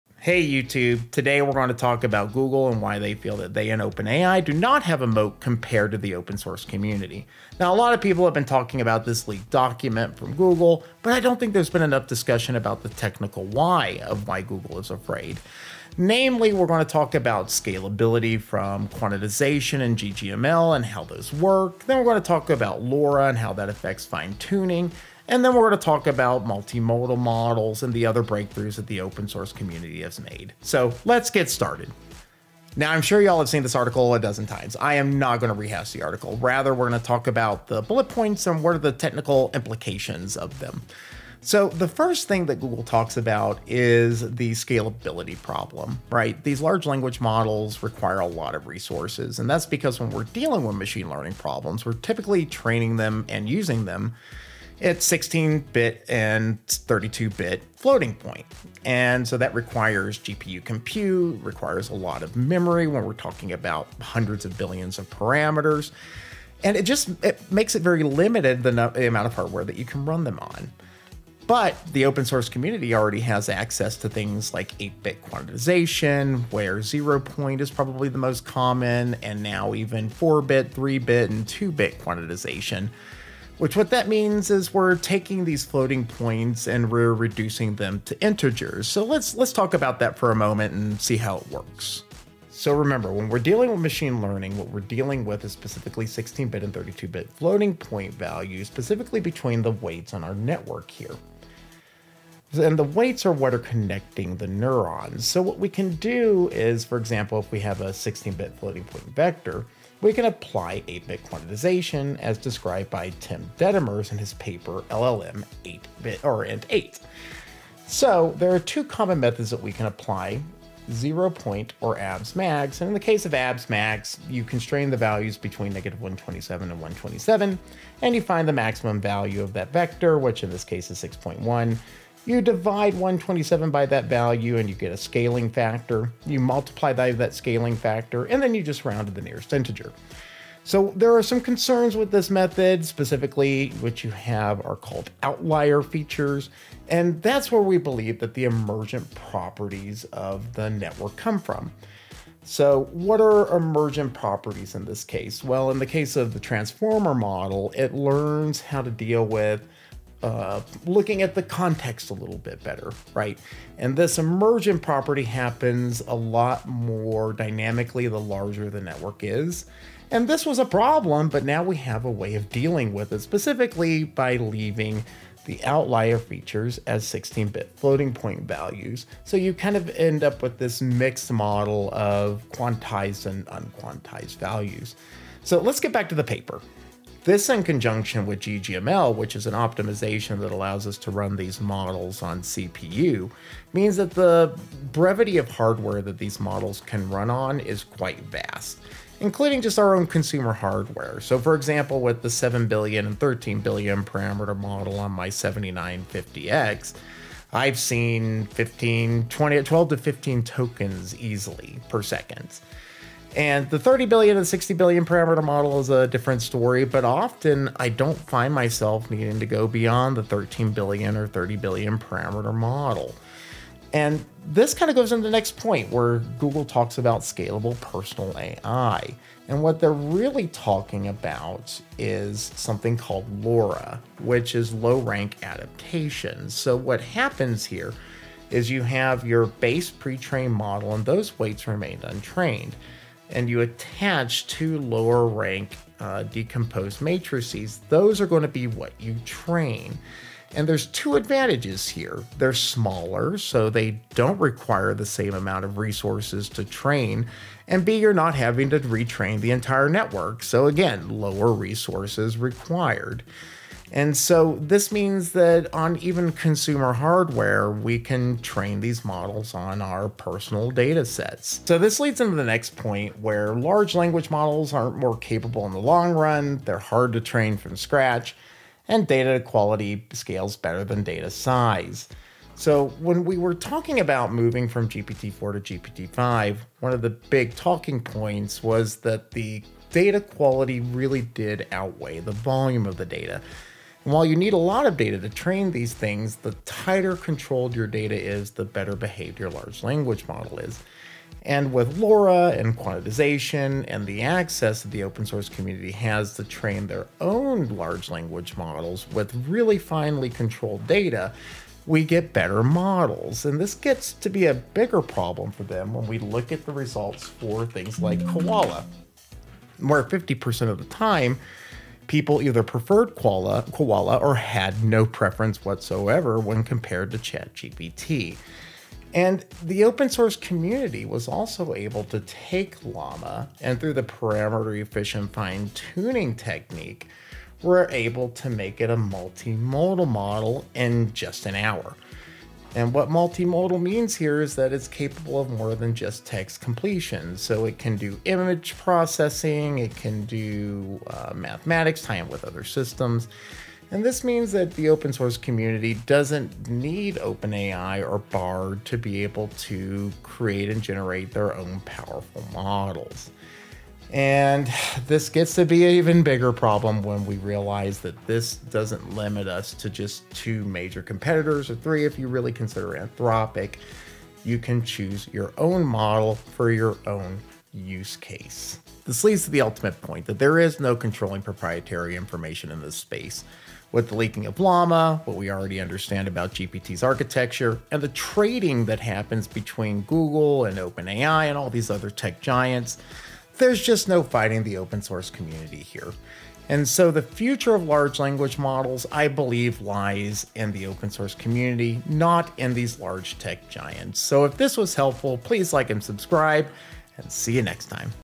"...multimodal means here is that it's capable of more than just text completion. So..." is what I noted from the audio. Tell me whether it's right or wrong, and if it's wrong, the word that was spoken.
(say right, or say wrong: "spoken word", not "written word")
right.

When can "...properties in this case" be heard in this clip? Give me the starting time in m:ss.
2:34.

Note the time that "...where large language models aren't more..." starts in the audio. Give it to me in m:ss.
4:33.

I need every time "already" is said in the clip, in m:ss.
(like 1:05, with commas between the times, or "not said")
1:12, 6:25.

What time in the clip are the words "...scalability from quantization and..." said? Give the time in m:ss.
0:17.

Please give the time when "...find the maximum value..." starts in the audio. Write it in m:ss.
2:08.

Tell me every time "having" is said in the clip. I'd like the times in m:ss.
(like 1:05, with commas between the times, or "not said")
4:18.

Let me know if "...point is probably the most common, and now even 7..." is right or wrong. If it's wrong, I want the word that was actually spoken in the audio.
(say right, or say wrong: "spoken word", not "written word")
wrong: "4", not "7".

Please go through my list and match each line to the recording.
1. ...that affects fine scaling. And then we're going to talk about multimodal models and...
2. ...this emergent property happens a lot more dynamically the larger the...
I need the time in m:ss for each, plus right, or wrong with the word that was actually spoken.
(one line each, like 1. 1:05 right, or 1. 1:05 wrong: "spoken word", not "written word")
1. 0:23 wrong: "tuning", not "scaling"
2. 2:43 right.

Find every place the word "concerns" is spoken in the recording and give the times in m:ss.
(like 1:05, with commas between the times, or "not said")
2:21.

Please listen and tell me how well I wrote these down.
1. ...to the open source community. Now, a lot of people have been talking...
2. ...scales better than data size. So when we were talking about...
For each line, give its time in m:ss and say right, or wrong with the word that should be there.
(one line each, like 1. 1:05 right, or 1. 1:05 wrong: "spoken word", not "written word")
1. 0:05 right
2. 4:40 right.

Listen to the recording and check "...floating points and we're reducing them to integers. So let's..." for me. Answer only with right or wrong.
right.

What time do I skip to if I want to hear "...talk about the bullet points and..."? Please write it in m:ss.
0:37.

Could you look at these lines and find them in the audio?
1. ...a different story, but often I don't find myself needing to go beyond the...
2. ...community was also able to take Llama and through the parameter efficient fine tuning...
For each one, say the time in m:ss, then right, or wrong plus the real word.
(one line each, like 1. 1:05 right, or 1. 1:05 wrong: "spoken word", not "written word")
1. 3:35 right
2. 5:30 right.